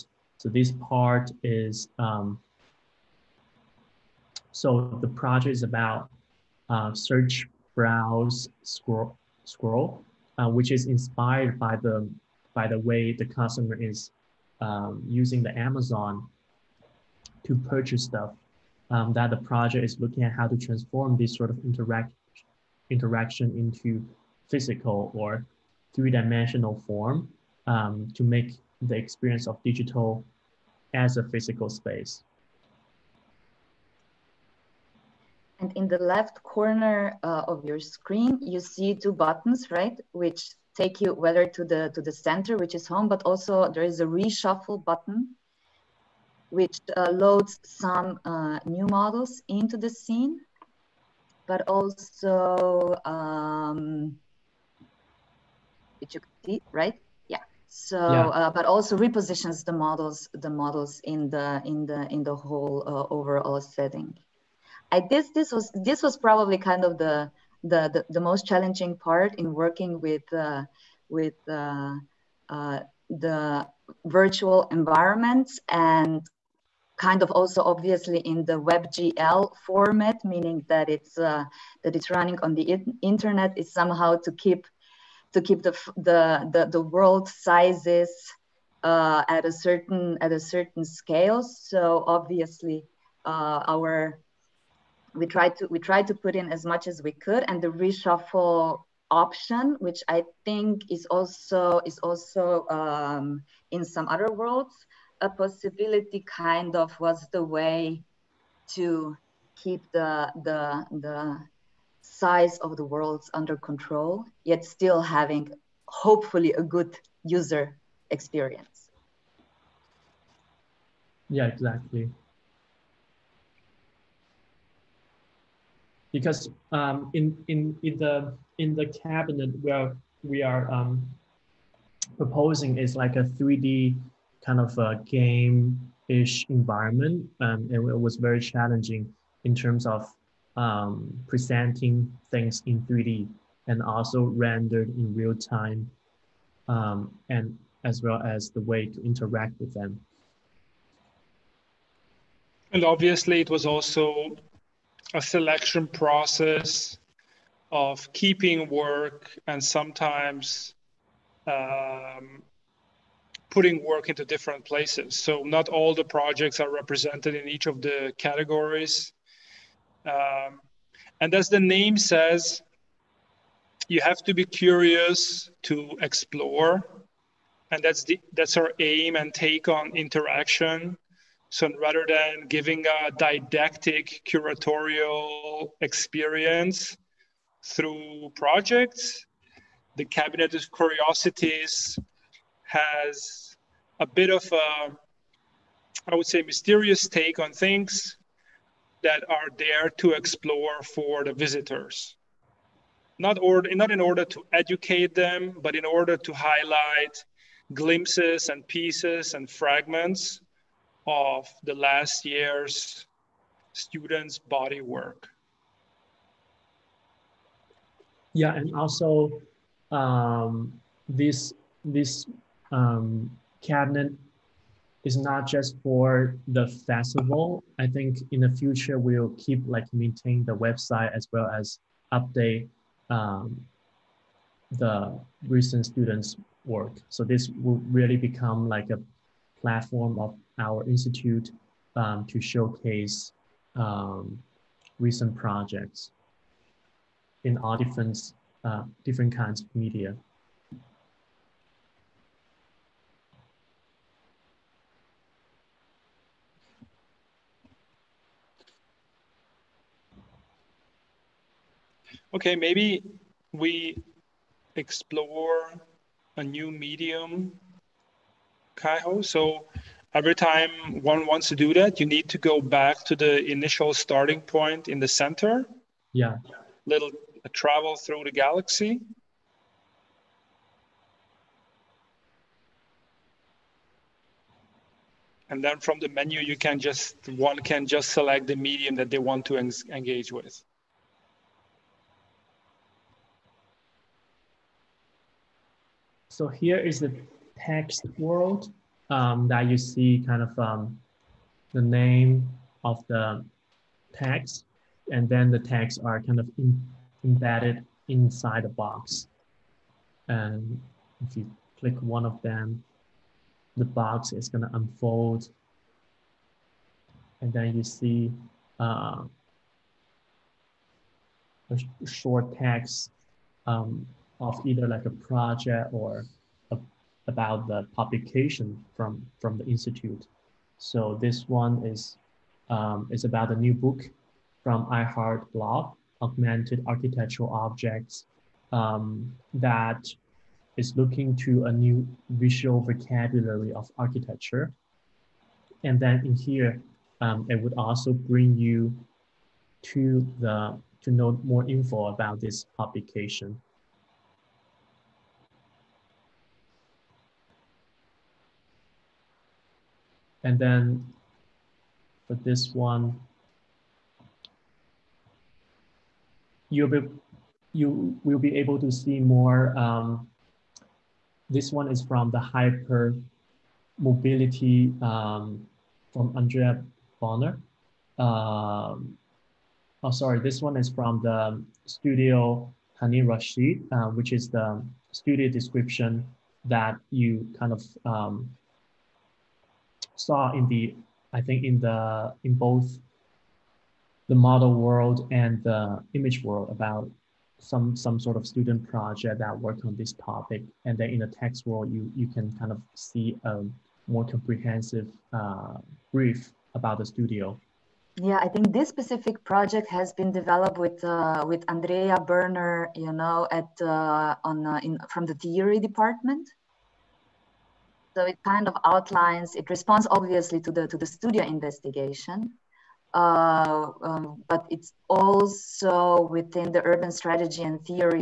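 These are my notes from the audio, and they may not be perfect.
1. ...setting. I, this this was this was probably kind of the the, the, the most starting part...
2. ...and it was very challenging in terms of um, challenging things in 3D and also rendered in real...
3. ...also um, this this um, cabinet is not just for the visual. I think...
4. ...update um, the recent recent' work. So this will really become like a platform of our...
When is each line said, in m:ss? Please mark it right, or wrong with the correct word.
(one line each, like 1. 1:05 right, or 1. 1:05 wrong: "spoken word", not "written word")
1. 1:03 wrong: "challenging", not "starting"
2. 2:17 wrong: "presenting", not "challenging"
3. 3:38 wrong: "festival", not "visual"
4. 3:52 wrong: "students", not "recent".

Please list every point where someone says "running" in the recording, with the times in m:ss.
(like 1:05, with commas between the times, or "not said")
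1:22.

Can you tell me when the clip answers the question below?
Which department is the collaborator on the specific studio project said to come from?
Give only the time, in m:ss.
6:55.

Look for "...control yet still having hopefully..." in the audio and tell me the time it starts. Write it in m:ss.
1:53.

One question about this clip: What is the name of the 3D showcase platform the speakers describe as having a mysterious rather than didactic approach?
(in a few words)
Cabinet of Curiosities.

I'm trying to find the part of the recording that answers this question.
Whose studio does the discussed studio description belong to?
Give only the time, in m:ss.
6:23.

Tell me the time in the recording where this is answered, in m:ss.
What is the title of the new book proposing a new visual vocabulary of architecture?
5:36.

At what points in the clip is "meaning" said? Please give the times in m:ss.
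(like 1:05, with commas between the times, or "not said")
1:20.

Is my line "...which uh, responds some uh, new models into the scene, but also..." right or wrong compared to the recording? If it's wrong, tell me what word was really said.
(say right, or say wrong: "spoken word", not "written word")
wrong: "loads", not "responds".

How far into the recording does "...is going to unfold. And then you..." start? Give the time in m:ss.
5:14.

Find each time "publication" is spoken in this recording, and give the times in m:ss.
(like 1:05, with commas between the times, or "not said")
5:27, 5:52.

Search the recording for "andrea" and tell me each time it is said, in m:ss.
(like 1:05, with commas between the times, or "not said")
6:16, 6:51.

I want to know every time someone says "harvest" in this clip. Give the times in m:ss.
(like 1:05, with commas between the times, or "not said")
not said.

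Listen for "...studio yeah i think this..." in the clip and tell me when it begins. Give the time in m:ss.
6:47.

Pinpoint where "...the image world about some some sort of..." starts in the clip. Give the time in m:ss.
6:35.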